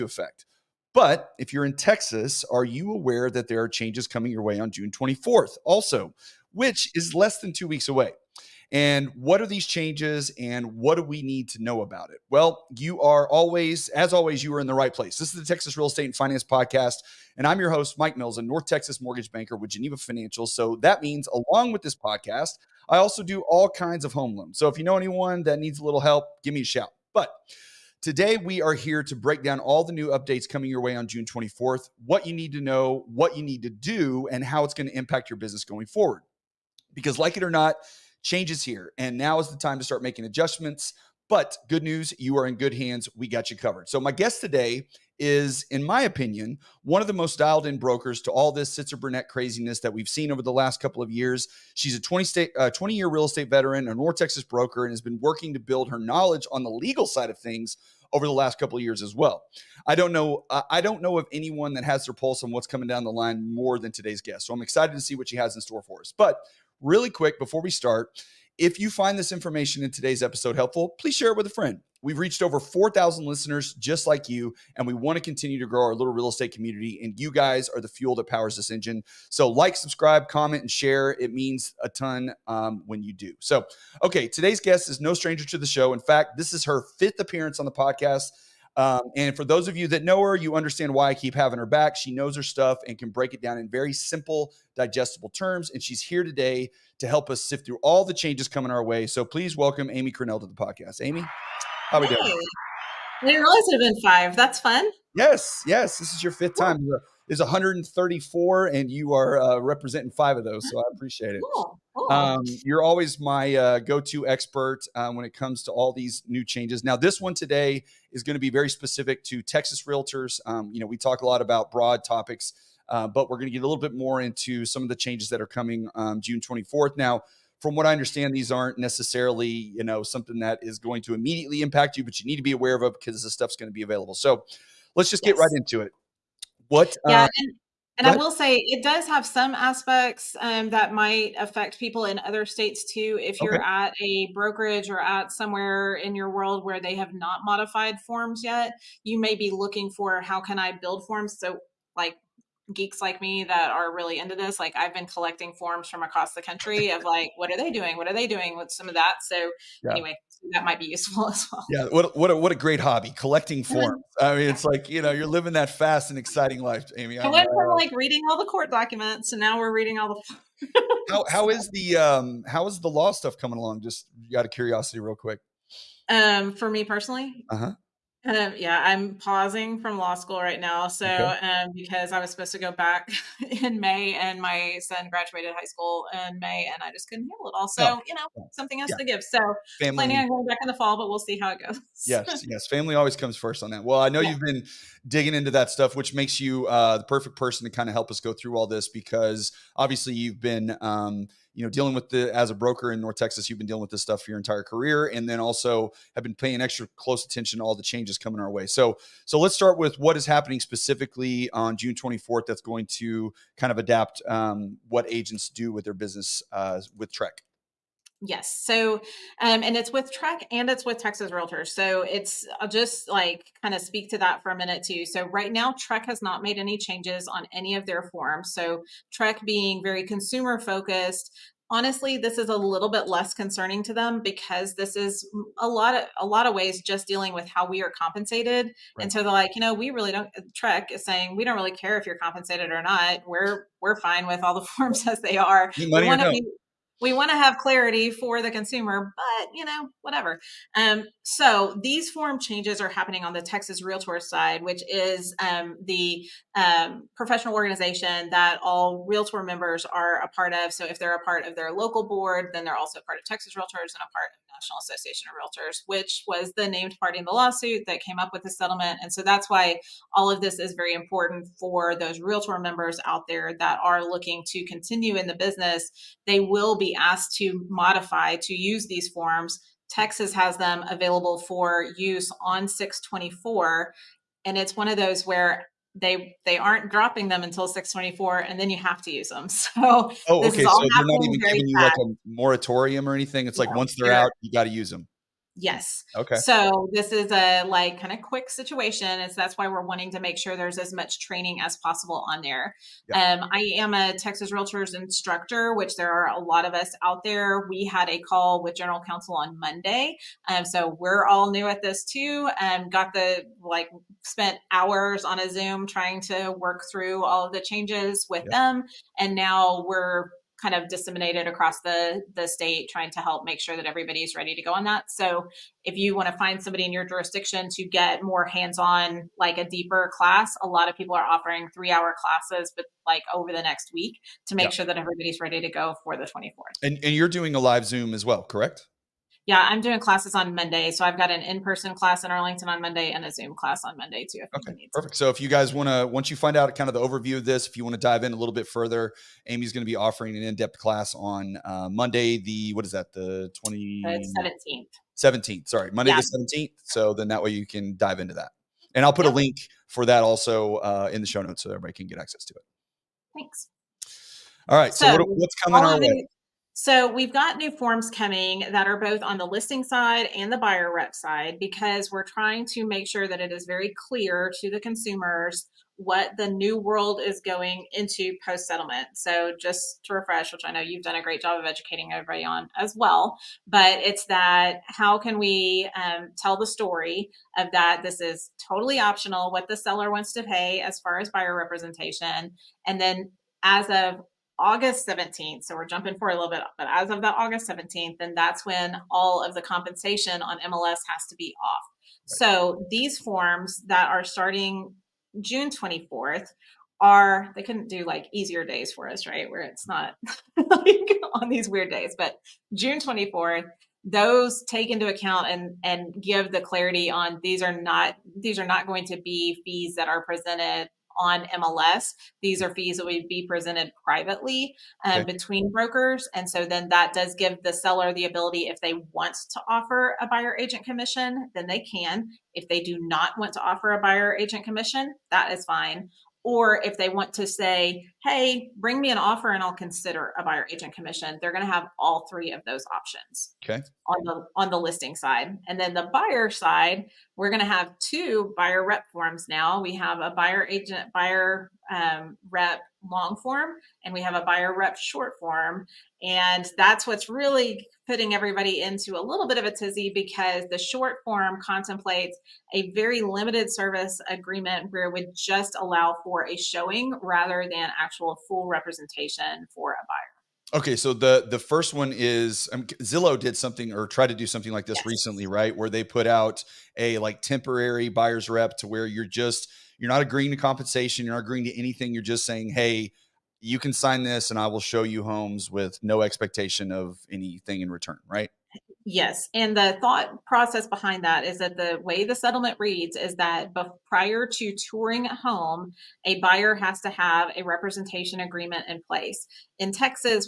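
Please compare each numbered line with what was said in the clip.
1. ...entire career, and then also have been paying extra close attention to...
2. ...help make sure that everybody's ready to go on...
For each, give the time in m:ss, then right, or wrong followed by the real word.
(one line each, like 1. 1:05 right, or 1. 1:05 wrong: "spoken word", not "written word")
1. 3:24 right
2. 5:23 right.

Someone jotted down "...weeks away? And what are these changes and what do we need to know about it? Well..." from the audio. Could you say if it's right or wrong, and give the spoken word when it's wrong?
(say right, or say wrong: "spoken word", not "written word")
right.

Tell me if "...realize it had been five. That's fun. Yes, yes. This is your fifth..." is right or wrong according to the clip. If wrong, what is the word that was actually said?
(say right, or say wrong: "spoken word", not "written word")
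right.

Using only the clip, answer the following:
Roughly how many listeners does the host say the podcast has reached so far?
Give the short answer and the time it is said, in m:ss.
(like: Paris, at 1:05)
4,000, at 1:12.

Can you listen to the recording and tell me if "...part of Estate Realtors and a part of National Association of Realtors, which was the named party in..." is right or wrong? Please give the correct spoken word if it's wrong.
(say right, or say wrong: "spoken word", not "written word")
wrong: "Texas", not "Estate".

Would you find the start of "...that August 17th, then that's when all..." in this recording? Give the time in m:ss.
6:37.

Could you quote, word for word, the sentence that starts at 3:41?
So it's, I'll uh, just like kind of speak to that for a minute too.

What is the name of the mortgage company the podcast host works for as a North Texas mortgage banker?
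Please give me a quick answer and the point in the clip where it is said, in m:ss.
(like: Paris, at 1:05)
Geneva Financial, at 0:19.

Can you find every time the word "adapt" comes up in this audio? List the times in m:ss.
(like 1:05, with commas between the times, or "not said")
3:33.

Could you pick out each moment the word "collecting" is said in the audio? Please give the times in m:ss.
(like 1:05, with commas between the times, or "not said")
2:35, 2:43.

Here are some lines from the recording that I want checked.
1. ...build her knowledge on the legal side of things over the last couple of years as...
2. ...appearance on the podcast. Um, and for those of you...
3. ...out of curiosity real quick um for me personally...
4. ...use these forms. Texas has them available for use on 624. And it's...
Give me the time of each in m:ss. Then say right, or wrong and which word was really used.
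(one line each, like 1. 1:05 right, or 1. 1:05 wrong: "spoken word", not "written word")
1. 0:55 right
2. 1:27 right
3. 2:54 right
4. 4:38 right.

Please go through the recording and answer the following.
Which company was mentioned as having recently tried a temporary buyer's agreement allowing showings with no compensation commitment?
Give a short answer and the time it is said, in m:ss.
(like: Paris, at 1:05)
Zillow, at 7:52.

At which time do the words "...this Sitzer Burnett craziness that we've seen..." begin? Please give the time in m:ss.
0:48.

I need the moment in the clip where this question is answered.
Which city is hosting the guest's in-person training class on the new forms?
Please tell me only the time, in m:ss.
5:42.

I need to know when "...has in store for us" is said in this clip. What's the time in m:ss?
1:05.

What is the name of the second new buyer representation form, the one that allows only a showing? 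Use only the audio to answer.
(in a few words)
buyer rep short form.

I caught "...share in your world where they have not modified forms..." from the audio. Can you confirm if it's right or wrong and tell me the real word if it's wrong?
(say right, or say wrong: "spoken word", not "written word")
wrong: "somewhere", not "share".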